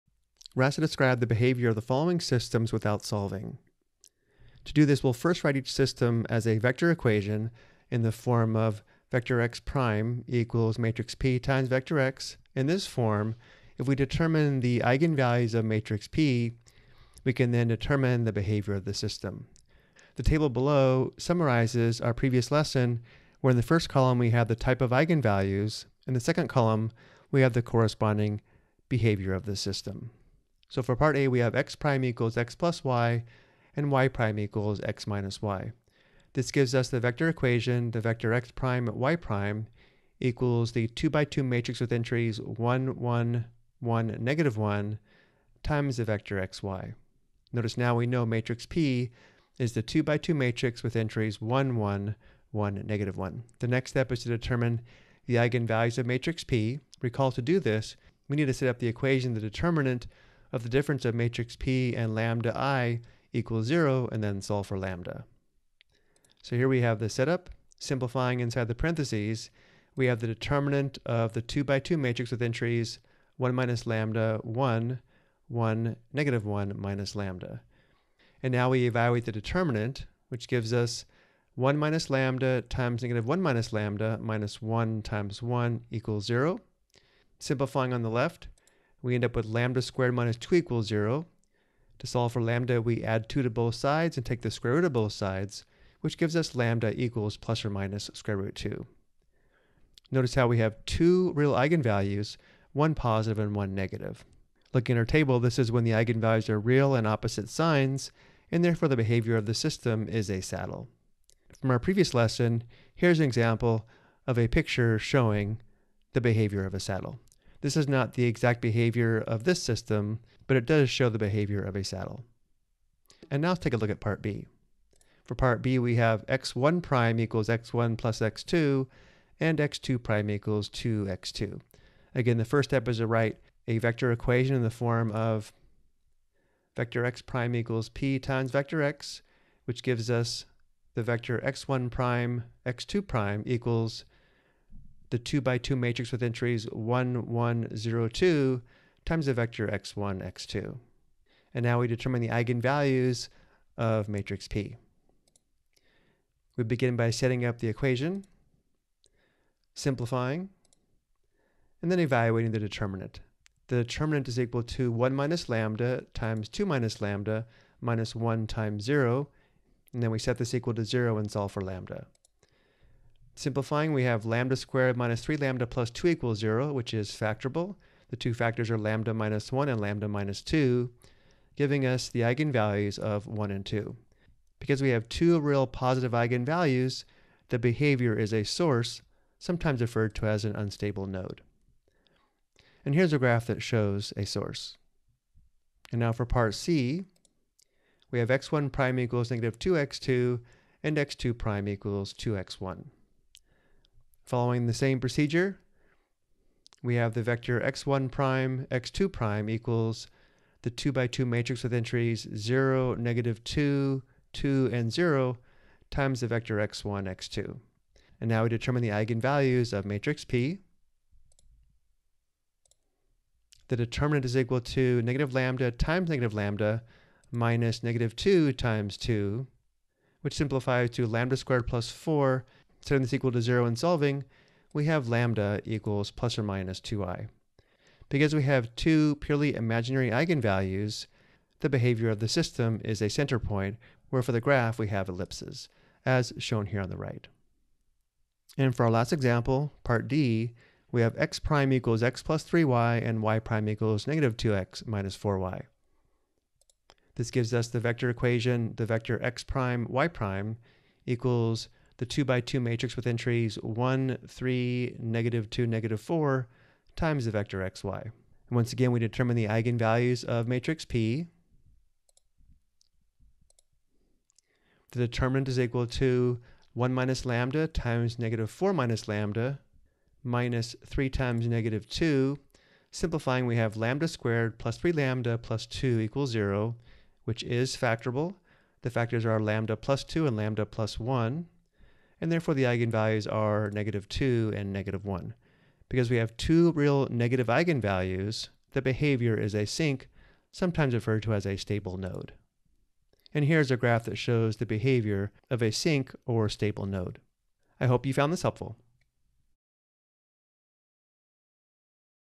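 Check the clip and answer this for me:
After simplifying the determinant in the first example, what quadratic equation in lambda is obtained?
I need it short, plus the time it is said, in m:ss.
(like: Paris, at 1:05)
lambda squared minus 2 equals 0, at 1:29.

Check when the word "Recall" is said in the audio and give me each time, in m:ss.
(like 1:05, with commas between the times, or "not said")
0:57.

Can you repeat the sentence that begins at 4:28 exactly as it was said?
And once again, we determine the eigenvalues of matrix P.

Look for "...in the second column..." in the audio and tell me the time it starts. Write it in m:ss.
0:26.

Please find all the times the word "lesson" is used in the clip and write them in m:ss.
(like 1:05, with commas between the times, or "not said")
0:22, 1:52.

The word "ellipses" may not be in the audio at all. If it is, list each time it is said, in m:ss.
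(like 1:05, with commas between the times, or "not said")
4:05.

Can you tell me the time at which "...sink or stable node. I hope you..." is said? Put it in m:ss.
5:05.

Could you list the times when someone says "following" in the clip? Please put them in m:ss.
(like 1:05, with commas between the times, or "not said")
0:01, 3:24.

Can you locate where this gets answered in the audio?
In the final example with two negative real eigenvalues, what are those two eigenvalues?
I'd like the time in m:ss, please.
4:53.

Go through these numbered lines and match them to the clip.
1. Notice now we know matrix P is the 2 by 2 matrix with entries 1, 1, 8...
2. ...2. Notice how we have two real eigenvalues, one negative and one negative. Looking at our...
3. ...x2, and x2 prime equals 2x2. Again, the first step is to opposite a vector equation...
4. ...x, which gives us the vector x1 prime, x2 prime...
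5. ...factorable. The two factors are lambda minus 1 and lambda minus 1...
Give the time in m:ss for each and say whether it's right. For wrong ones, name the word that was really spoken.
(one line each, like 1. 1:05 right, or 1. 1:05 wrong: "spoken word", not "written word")
1. 0:47 wrong: "1", not "8"
2. 1:38 wrong: "positive", not "negative"
3. 2:08 wrong: "write", not "opposite"
4. 2:18 right
5. 2:57 wrong: "2", not "1".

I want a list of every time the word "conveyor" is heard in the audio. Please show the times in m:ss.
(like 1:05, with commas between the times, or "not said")
not said.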